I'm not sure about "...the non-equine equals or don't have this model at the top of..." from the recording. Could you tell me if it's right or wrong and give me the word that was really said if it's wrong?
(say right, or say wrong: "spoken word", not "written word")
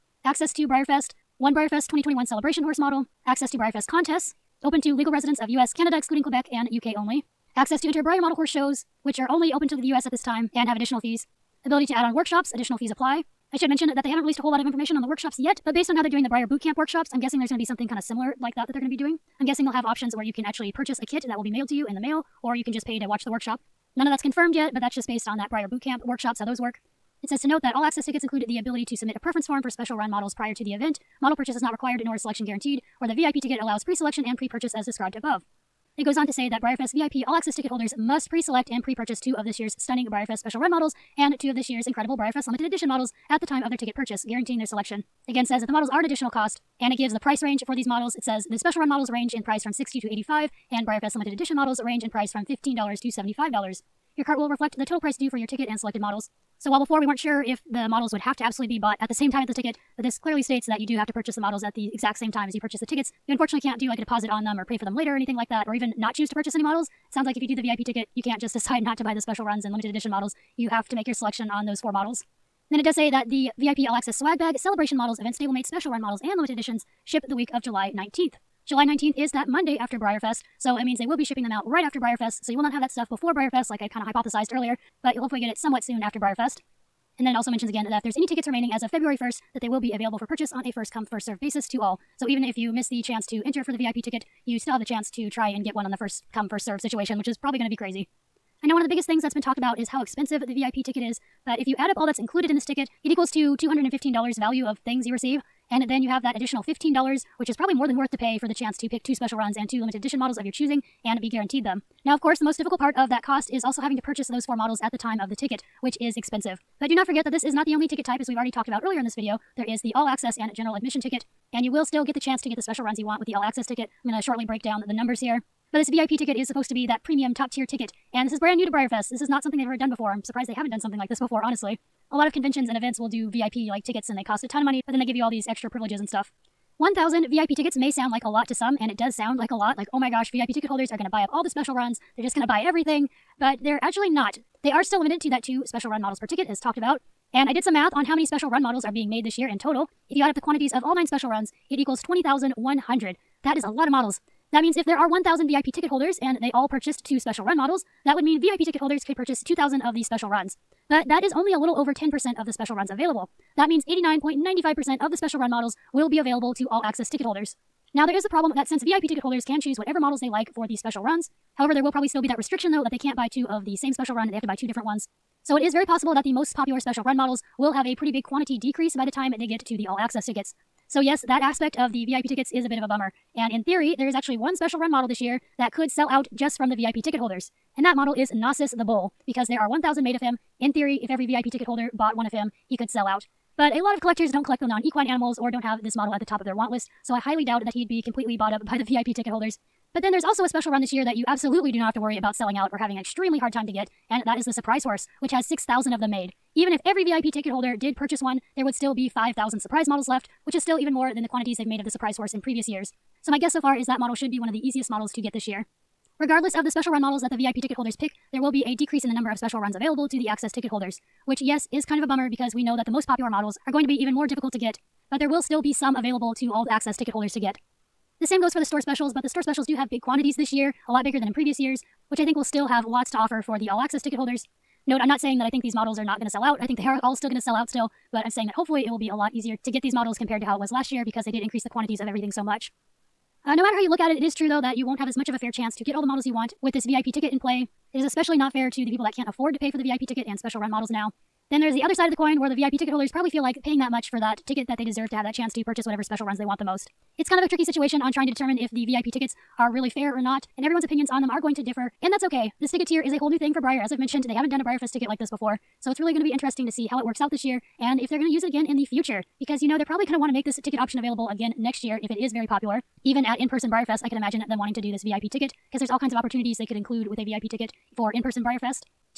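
wrong: "animals", not "equals".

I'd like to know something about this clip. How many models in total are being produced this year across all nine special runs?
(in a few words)
20,100.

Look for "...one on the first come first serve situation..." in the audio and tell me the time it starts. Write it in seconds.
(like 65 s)
95 s.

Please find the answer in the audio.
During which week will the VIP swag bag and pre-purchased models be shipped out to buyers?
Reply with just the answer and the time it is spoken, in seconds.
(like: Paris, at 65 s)
Week of July 19th, at 77 s.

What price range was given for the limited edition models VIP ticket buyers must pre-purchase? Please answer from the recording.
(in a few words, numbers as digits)
$15 to $75.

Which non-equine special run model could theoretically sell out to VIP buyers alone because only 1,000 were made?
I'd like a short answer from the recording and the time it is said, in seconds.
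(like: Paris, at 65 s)
Gnosis the Bull, at 188 s.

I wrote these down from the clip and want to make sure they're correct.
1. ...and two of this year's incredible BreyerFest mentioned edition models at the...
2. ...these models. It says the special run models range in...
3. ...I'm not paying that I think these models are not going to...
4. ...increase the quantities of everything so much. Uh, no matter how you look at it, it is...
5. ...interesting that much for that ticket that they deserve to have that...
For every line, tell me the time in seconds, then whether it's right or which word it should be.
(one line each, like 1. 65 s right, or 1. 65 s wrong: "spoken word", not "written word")
1. 41 s wrong: "limited", not "mentioned"
2. 47 s right
3. 235 s wrong: "saying", not "paying"
4. 241 s right
5. 253 s wrong: "paying", not "interesting".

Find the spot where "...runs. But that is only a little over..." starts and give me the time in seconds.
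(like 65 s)
160 s.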